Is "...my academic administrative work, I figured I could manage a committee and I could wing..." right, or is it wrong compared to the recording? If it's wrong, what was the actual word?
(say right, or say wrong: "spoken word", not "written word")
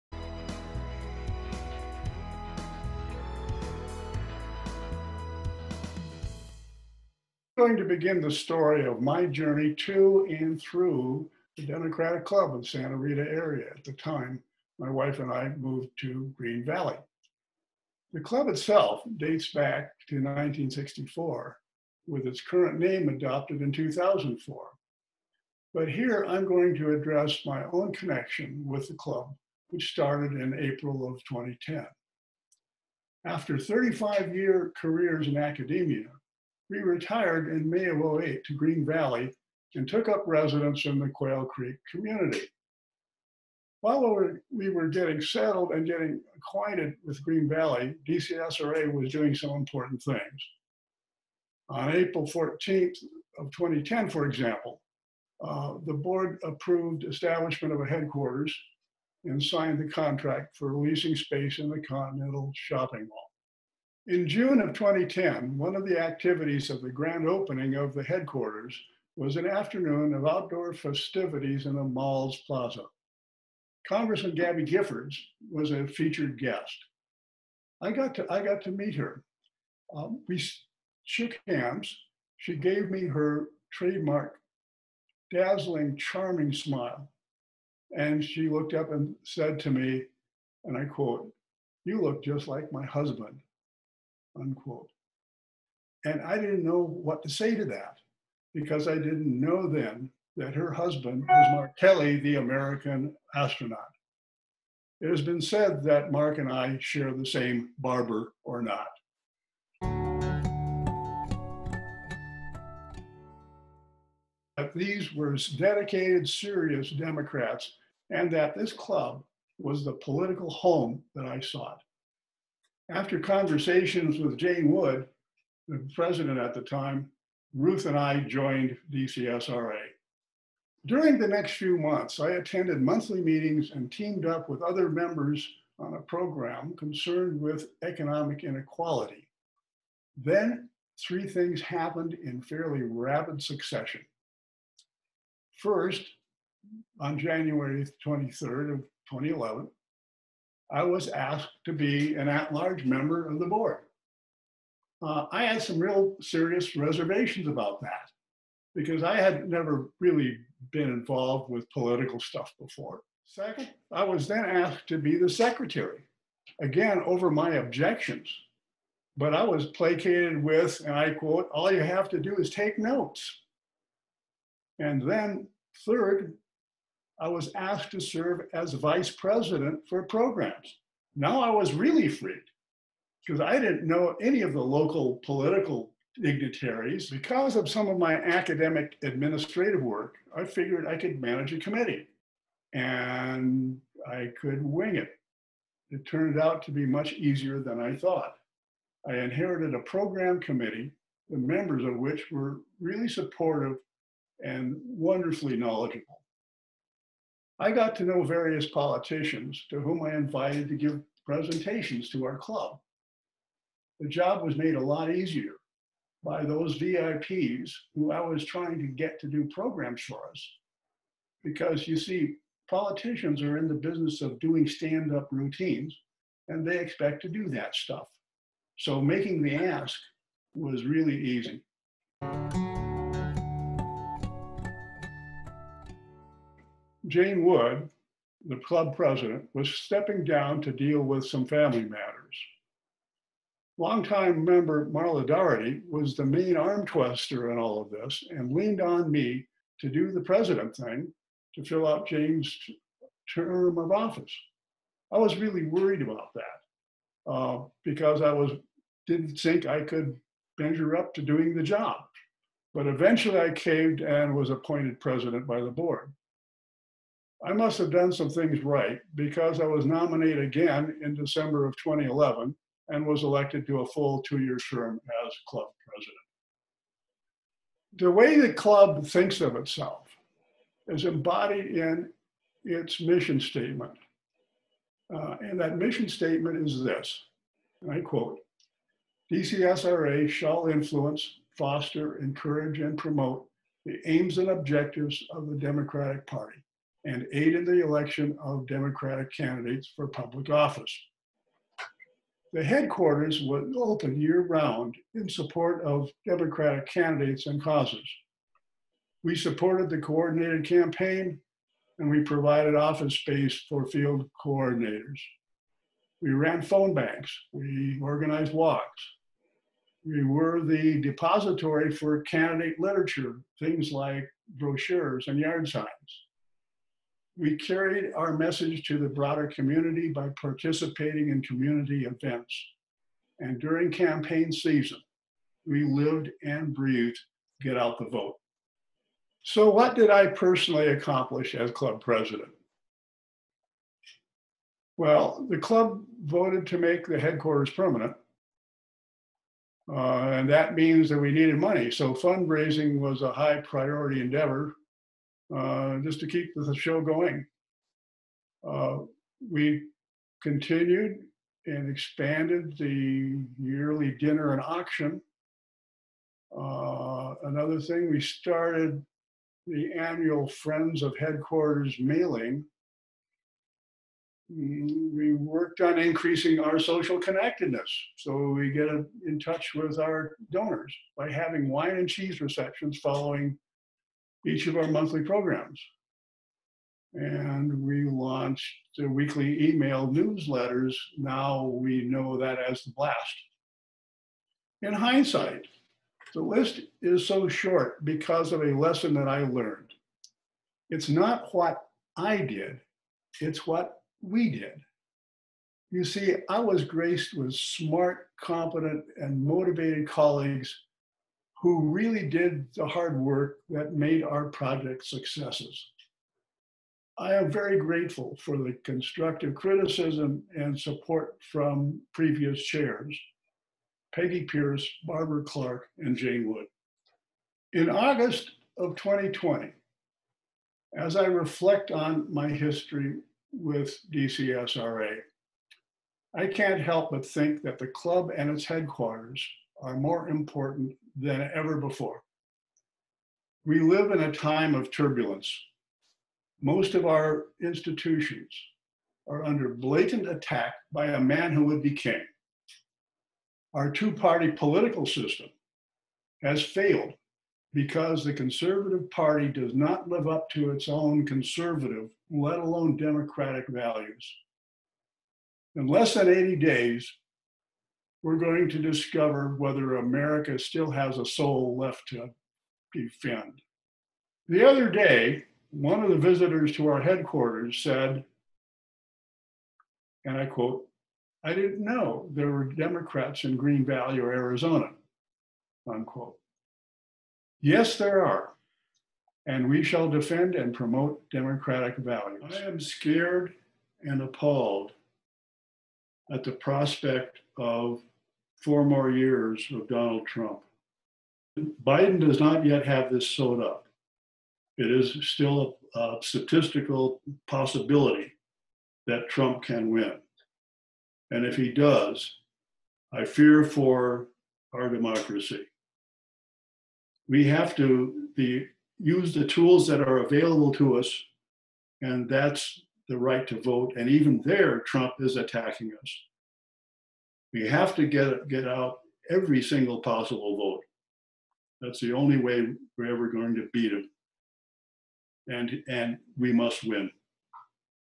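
right.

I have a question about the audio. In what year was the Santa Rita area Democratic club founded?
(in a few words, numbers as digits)
1964.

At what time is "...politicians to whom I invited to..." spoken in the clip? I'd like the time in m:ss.
3:28.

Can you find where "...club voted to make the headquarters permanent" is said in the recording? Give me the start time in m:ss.
5:45.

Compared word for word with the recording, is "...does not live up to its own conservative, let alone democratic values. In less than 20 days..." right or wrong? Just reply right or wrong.
wrong.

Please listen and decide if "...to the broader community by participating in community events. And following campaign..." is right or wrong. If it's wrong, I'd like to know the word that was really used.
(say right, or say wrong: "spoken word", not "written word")
wrong: "during", not "following".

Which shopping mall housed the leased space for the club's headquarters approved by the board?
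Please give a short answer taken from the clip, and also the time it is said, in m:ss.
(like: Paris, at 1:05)
Continental Shopping Mall, at 1:01.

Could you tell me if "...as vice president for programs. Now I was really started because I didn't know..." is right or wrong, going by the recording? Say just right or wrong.
wrong.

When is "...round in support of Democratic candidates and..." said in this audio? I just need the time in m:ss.
5:04.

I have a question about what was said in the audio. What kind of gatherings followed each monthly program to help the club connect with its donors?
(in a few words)
Wine and cheese receptions.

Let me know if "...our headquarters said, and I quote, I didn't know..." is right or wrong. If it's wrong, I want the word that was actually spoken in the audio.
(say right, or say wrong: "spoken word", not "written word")
right.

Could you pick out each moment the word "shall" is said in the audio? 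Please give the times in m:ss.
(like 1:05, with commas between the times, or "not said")
4:50, 8:09.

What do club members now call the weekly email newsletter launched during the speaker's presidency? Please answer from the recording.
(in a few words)
The blast.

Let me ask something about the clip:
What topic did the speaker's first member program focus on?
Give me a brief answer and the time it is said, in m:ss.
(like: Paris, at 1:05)
Economic inequality, at 2:17.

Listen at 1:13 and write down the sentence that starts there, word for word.
Congressman Gabby Giffords was a featured guest.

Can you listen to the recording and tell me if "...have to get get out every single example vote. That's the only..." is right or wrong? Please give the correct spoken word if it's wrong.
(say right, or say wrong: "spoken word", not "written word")
wrong: "possible", not "example".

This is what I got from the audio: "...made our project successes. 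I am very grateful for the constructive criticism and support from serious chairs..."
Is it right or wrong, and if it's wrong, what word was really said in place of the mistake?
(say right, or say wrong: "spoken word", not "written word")
wrong: "previous", not "serious".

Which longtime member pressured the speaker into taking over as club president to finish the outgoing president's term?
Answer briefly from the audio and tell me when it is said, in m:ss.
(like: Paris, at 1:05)
Marla Daugherty, at 4:04.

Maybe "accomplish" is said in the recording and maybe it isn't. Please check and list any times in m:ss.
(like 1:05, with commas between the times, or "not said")
5:40.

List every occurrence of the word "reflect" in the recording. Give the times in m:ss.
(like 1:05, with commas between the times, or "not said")
7:11.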